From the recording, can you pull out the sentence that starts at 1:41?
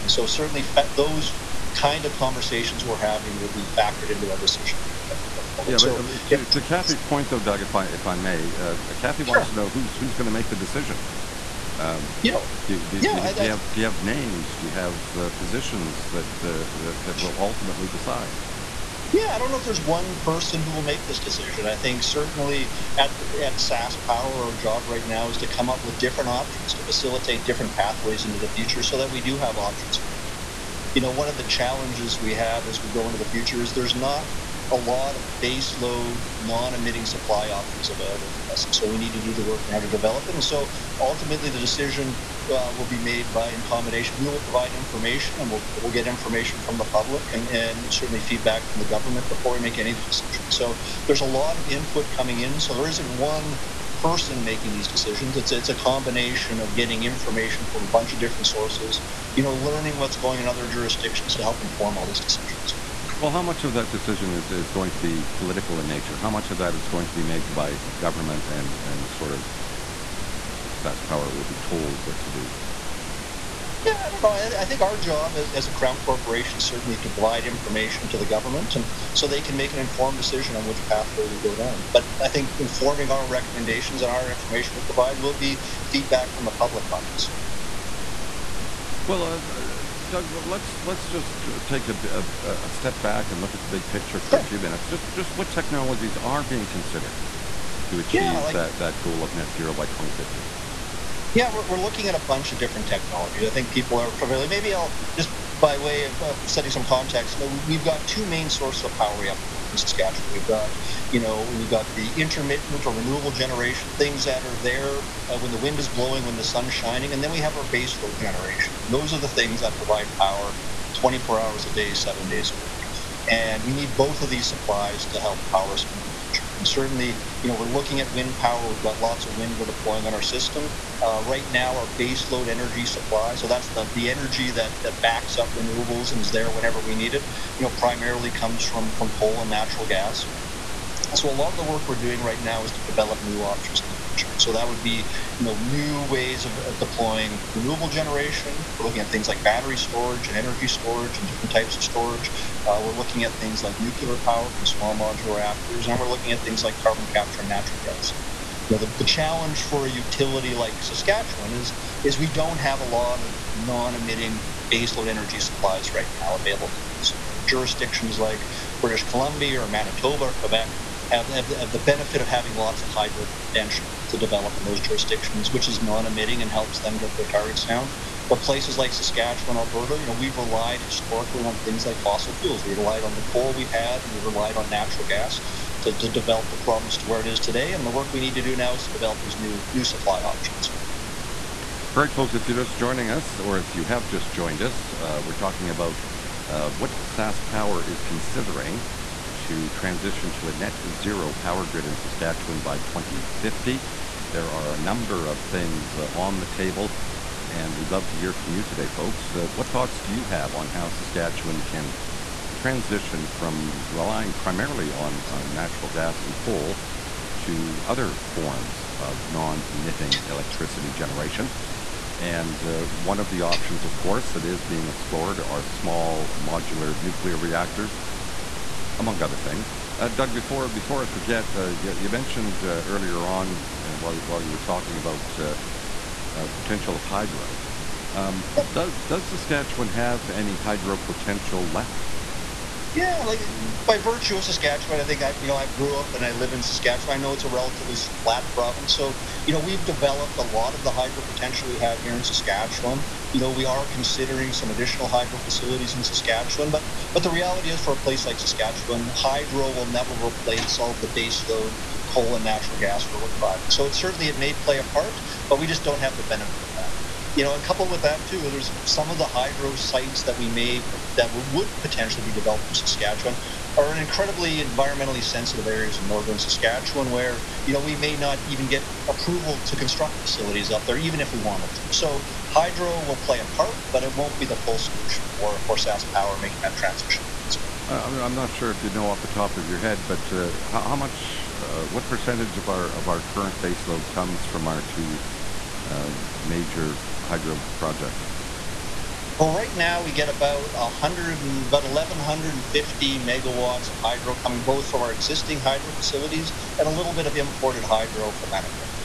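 Yeah, we're, we're looking at a bunch of different technologies.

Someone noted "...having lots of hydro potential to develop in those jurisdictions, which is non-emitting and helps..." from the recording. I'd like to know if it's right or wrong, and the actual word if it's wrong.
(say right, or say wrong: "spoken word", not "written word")
right.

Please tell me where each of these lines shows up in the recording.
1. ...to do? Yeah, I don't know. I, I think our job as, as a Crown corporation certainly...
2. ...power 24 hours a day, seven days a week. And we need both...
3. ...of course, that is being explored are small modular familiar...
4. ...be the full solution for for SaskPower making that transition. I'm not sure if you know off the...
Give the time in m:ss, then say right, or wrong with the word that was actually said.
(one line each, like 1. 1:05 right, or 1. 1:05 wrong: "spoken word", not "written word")
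1. 1:12 right
2. 2:00 right
3. 3:43 wrong: "nuclear", not "familiar"
4. 4:44 right.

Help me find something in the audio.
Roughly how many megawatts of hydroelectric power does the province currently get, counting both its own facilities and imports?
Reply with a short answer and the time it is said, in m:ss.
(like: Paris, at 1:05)
1150, at 5:01.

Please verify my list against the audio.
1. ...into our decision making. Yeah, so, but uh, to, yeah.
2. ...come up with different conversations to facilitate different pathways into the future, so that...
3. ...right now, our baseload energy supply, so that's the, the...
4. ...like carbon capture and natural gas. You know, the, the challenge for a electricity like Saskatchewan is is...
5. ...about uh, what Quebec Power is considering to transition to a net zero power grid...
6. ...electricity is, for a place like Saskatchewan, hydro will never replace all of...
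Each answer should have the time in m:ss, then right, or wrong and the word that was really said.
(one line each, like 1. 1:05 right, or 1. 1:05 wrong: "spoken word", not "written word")
1. 0:04 right
2. 0:25 wrong: "options", not "conversations"
3. 2:11 right
4. 2:36 wrong: "utility", not "electricity"
5. 3:15 wrong: "Sask", not "Quebec"
6. 4:17 wrong: "reality", not "electricity".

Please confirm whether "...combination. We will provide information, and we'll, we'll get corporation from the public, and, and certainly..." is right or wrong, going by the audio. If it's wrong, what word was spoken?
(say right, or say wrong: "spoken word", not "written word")
wrong: "information", not "corporation".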